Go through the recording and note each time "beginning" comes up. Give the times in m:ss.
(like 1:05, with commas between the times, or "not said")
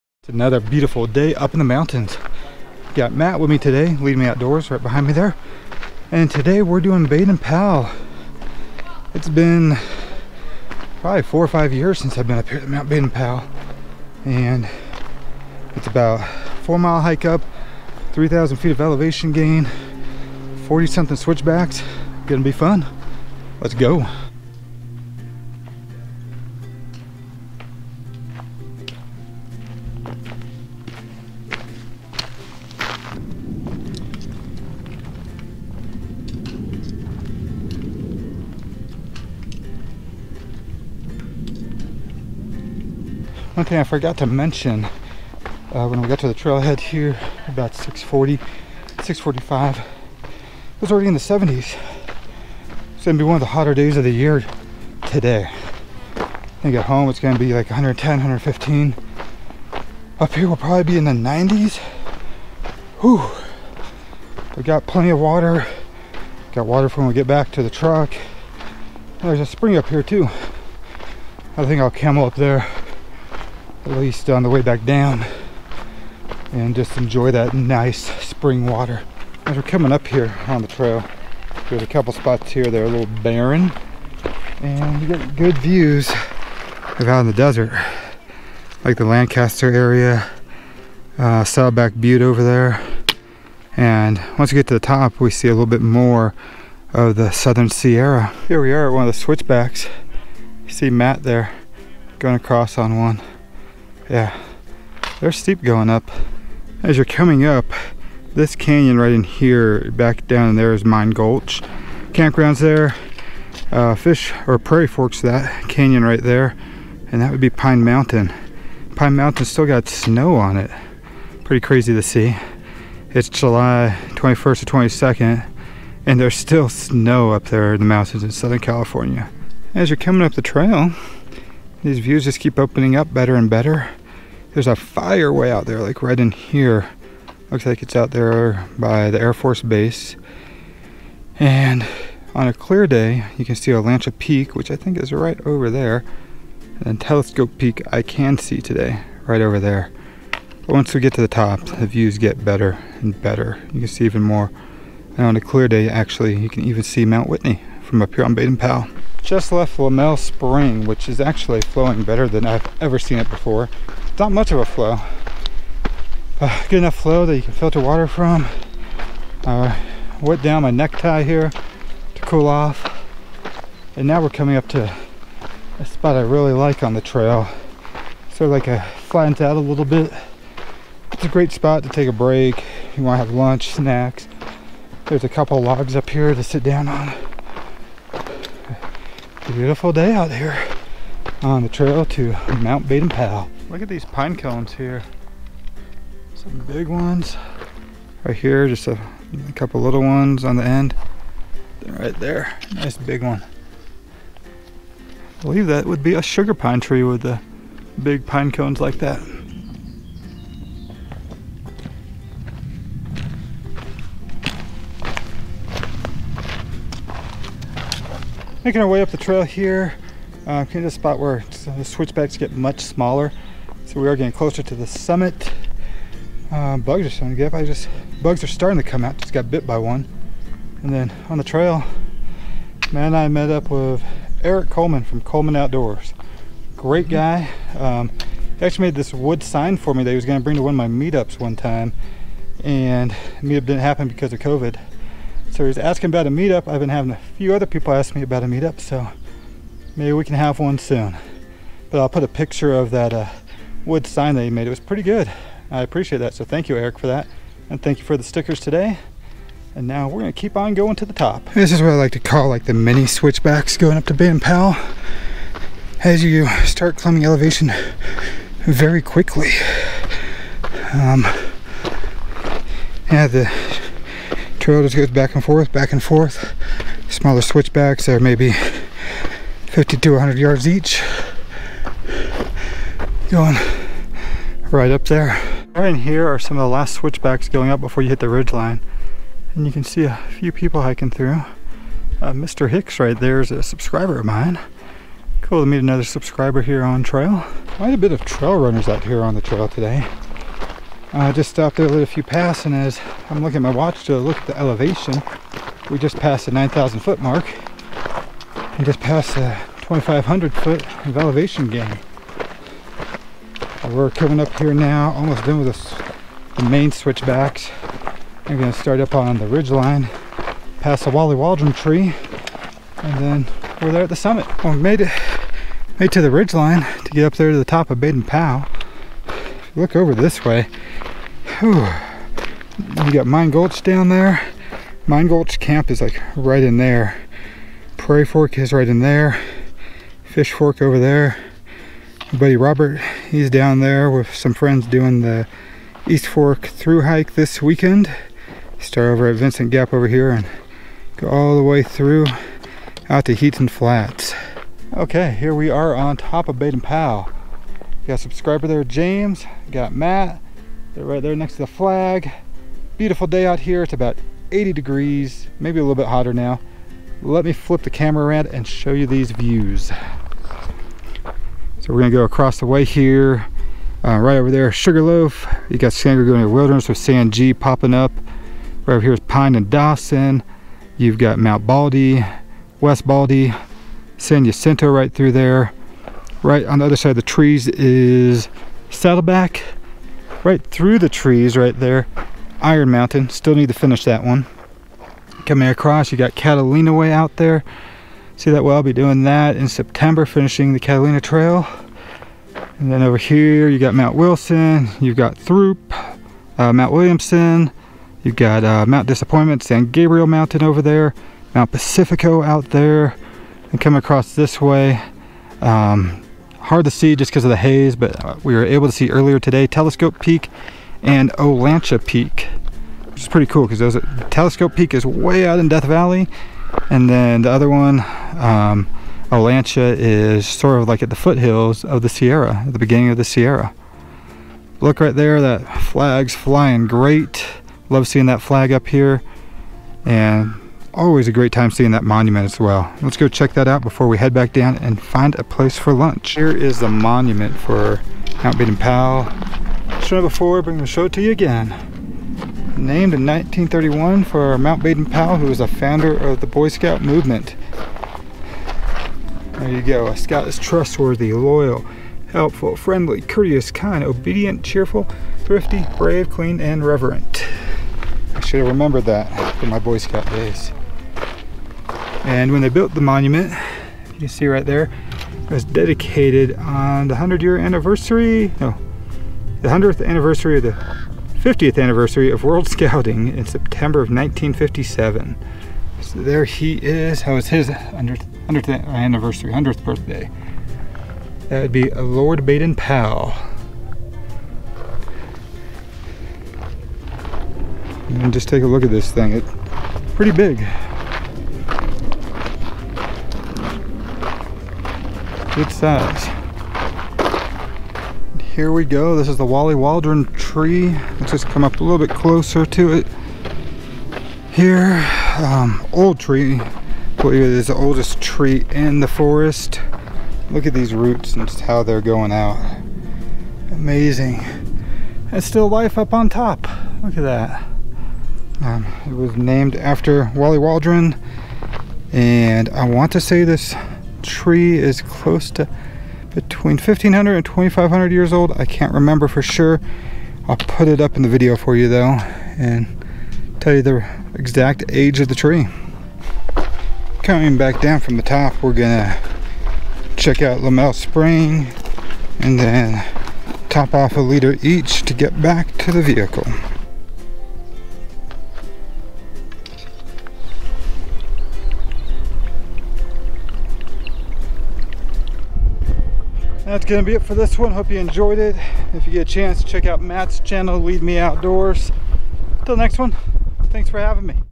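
7:12.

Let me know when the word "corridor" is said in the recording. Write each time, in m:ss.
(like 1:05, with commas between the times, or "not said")
not said.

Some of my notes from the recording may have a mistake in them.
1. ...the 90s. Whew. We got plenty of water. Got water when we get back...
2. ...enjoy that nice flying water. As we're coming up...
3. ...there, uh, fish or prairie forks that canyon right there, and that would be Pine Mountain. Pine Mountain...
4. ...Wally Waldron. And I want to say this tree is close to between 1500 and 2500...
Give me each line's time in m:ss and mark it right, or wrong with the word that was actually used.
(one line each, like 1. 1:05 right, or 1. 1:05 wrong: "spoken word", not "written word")
1. 1:01 right
2. 1:16 wrong: "spring", not "flying"
3. 1:52 right
4. 8:50 right.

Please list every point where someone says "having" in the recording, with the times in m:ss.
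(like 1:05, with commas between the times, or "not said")
4:06, 9:33.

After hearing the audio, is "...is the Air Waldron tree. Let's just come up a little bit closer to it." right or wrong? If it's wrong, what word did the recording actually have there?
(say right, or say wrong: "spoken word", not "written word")
wrong: "Wally", not "Air".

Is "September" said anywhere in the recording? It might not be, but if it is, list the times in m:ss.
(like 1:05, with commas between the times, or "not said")
6:39, 8:03.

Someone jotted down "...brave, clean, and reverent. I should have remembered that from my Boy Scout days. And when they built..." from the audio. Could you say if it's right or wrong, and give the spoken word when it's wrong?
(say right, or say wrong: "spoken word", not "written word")
right.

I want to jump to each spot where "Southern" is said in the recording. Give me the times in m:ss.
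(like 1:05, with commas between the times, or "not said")
1:37, 2:08.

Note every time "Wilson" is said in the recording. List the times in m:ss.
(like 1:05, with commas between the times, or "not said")
6:44.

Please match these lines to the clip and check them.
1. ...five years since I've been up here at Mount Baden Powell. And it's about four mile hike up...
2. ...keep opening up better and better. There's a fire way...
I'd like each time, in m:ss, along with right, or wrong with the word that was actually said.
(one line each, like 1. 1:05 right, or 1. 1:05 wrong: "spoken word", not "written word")
1. 0:11 right
2. 2:12 right.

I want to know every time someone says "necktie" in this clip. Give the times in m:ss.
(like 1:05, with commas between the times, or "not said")
2:50.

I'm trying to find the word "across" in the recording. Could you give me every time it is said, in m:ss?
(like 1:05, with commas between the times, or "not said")
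1:42, 6:12, 6:35, 6:53.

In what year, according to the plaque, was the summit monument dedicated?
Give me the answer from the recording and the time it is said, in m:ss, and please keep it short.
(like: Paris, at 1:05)
1957, at 8:04.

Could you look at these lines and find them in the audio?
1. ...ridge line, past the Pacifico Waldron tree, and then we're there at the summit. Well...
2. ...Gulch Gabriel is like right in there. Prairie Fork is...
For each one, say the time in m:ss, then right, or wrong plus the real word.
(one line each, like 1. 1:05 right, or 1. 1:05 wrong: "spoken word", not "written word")
1. 5:19 wrong: "Wally", not "Pacifico"
2. 5:35 wrong: "Camp", not "Gabriel".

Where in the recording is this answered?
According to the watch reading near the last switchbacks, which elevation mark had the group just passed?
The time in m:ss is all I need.
5:06.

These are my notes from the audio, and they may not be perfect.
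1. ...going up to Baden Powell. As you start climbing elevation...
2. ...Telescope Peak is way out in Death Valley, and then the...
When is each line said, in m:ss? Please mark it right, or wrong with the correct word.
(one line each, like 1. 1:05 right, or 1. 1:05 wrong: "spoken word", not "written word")
1. 4:23 right
2. 7:04 right.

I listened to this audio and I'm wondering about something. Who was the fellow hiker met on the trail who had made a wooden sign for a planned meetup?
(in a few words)
Eric Coleman.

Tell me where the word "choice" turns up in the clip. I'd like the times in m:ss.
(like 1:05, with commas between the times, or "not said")
not said.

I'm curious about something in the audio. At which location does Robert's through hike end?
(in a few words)
Heaton Flats.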